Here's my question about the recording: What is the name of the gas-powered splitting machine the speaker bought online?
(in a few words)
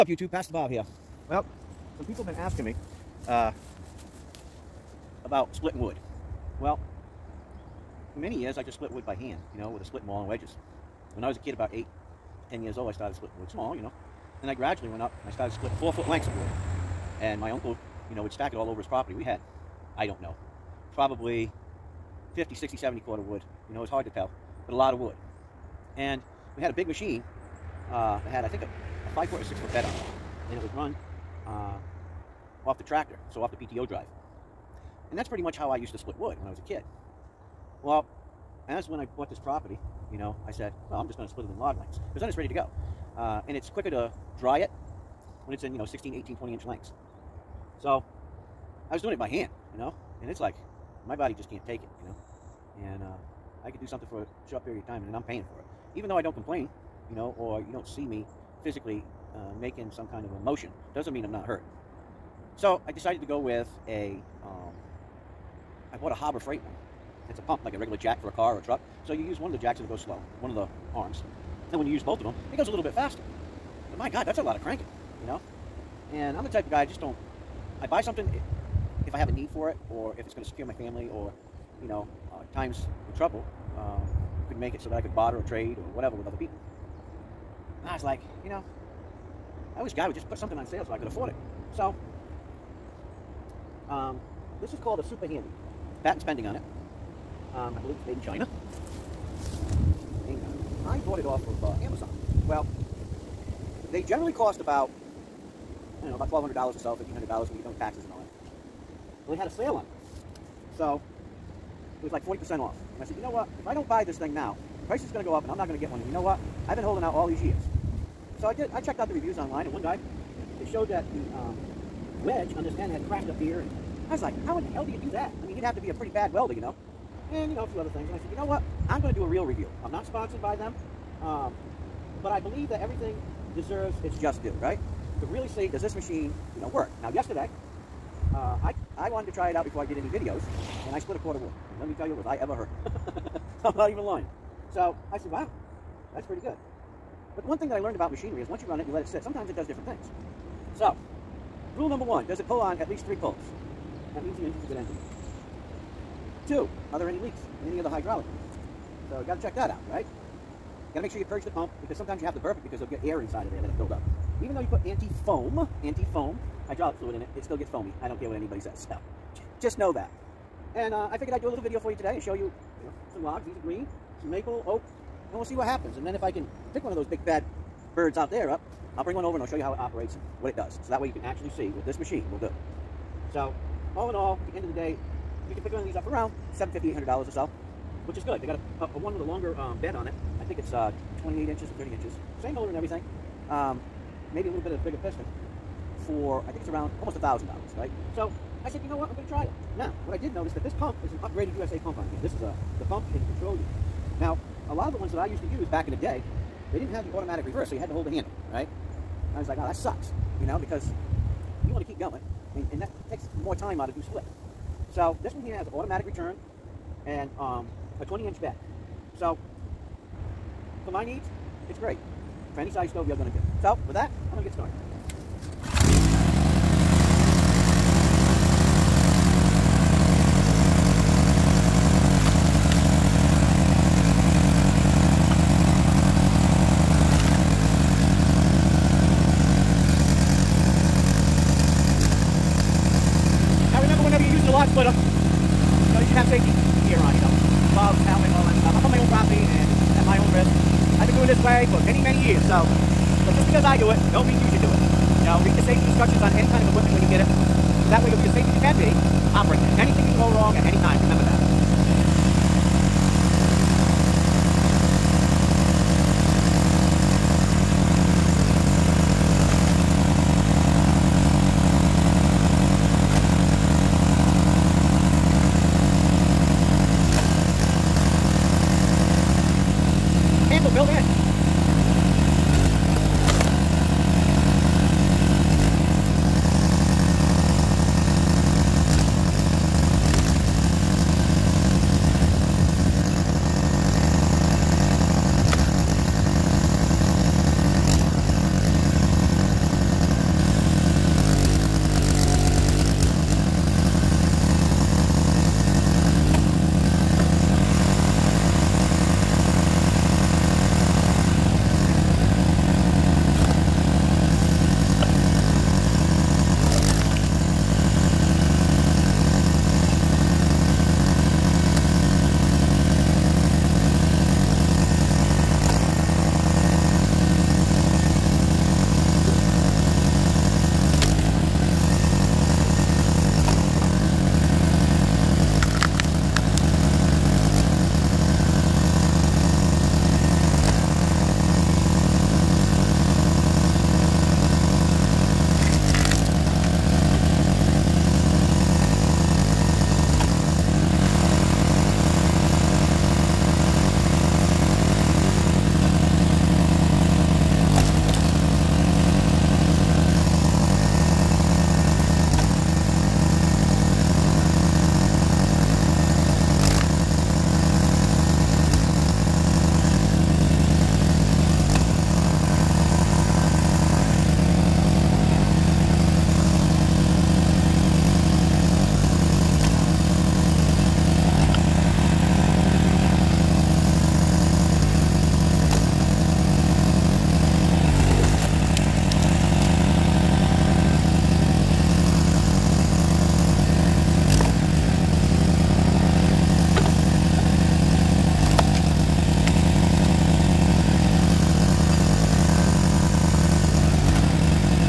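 Super Handy.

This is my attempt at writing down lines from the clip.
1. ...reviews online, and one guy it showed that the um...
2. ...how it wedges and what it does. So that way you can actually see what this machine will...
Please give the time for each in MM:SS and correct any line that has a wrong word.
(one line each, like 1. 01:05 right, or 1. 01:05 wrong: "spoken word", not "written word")
1. 01:59 right
2. 02:59 wrong: "operates", not "wedges".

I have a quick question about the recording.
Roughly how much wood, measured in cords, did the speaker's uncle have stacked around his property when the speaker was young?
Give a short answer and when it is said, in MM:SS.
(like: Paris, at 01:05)
50, 60, 70 cord, at 00:22.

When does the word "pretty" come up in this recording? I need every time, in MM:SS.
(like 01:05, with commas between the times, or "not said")
00:35, 02:05, 02:26.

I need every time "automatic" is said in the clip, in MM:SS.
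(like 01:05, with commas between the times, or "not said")
03:27, 03:35.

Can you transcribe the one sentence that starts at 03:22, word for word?
This is a, uh, the pump in the control unit.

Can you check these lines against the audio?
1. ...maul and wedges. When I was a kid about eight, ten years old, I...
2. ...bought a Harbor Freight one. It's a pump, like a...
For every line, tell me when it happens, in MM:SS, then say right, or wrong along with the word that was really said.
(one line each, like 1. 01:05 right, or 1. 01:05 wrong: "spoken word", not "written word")
1. 00:10 right
2. 01:05 right.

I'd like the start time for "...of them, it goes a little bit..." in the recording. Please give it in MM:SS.
01:12.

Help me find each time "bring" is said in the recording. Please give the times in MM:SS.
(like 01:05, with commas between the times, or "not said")
02:59.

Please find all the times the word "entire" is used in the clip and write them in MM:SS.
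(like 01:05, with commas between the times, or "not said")
not said.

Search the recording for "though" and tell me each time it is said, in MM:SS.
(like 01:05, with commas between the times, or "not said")
00:56, 02:44.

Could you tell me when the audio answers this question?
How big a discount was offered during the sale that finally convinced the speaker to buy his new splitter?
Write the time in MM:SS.
01:52.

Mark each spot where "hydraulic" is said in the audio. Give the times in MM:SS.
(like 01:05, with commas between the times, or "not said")
02:37, 02:46.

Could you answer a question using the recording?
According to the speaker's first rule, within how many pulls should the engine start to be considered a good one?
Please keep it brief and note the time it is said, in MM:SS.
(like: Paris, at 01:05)
3 pulls, at 02:33.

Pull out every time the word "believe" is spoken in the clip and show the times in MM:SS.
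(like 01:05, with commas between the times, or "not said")
01:37, 02:12.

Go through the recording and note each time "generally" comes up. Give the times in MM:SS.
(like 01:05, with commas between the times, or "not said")
01:44.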